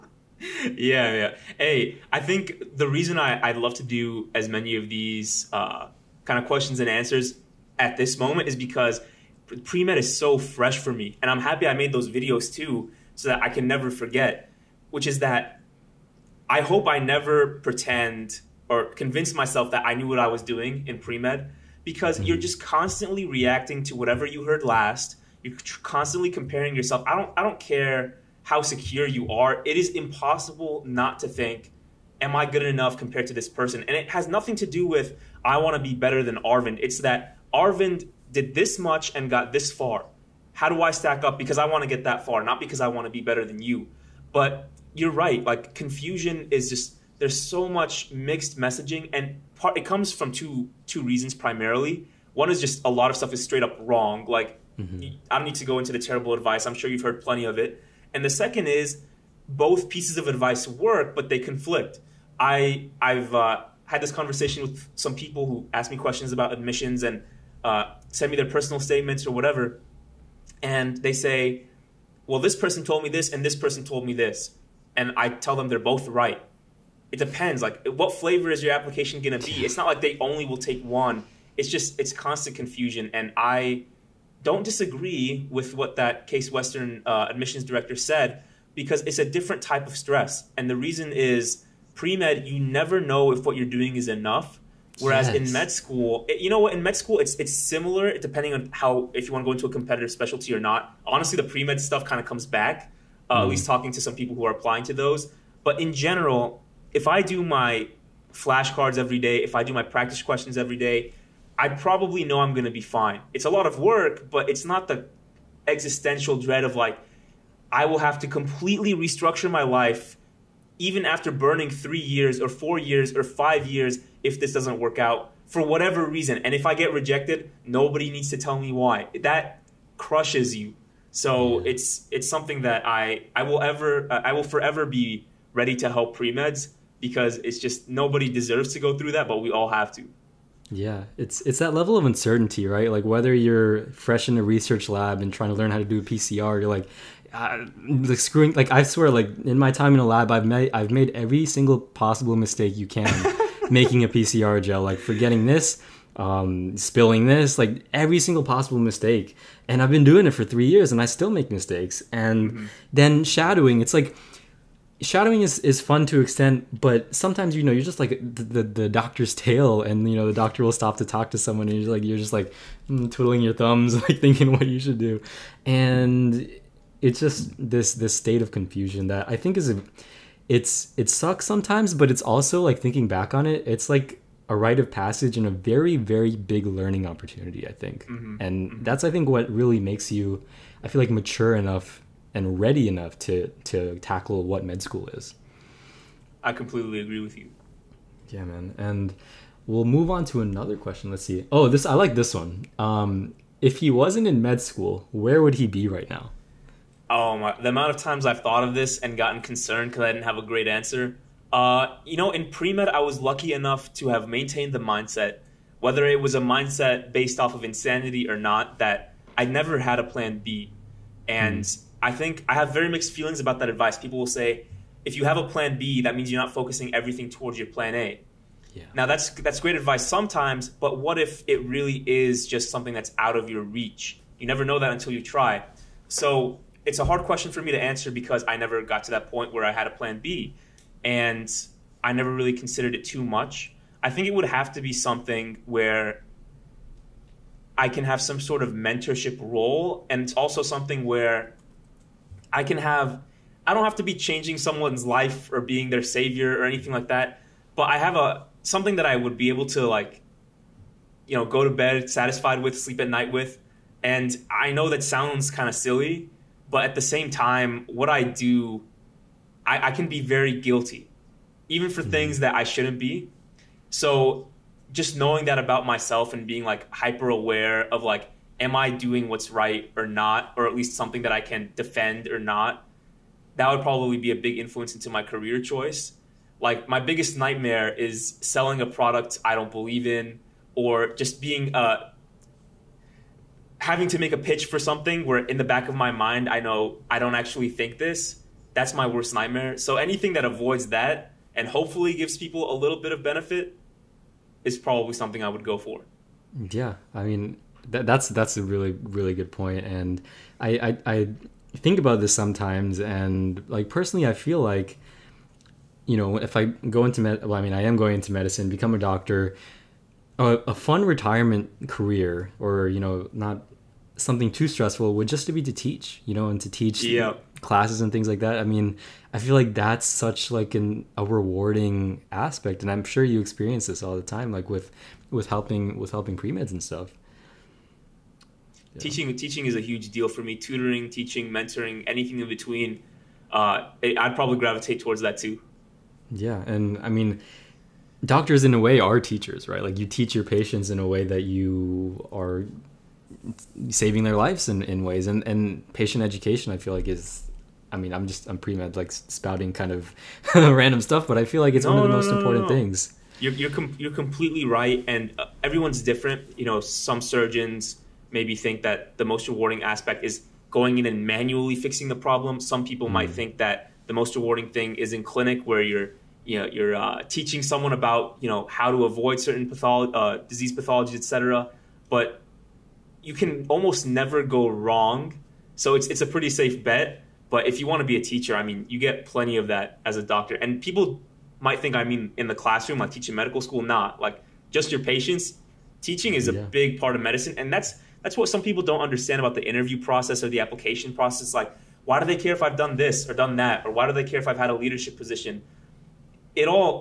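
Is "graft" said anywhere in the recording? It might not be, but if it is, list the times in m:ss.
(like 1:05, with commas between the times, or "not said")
not said.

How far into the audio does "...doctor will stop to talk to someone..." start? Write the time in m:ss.
2:50.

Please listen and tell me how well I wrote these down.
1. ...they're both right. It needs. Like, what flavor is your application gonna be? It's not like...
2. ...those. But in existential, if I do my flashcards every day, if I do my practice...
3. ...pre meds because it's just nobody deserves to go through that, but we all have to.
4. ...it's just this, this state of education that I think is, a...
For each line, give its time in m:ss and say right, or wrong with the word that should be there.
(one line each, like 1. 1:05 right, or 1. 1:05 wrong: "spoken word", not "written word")
1. 1:15 wrong: "depends", not "needs"
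2. 1:44 wrong: "general", not "existential"
3. 2:16 right
4. 2:57 wrong: "confusion", not "education".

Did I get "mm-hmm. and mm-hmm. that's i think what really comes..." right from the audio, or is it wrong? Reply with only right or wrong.
wrong.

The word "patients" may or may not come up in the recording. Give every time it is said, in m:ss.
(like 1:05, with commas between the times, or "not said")
5:50, 5:55, 6:35.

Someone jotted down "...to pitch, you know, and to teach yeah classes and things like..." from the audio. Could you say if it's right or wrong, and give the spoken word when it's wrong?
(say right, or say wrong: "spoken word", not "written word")
wrong: "teach", not "pitch".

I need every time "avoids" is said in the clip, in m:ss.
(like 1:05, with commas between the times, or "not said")
5:00, 6:19.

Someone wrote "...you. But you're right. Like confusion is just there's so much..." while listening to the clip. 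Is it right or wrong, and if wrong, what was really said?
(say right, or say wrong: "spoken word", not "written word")
right.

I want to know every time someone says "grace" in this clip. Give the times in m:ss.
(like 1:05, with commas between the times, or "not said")
not said.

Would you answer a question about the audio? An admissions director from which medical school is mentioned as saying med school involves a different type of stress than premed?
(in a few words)
Case Western.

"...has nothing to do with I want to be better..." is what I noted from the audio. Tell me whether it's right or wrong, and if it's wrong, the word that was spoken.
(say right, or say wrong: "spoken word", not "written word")
right.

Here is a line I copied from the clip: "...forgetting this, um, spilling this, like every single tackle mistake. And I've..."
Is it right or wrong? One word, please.
wrong.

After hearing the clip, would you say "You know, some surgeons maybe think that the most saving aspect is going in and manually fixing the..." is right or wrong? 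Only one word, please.
wrong.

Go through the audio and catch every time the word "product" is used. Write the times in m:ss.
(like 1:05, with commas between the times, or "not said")
4:48.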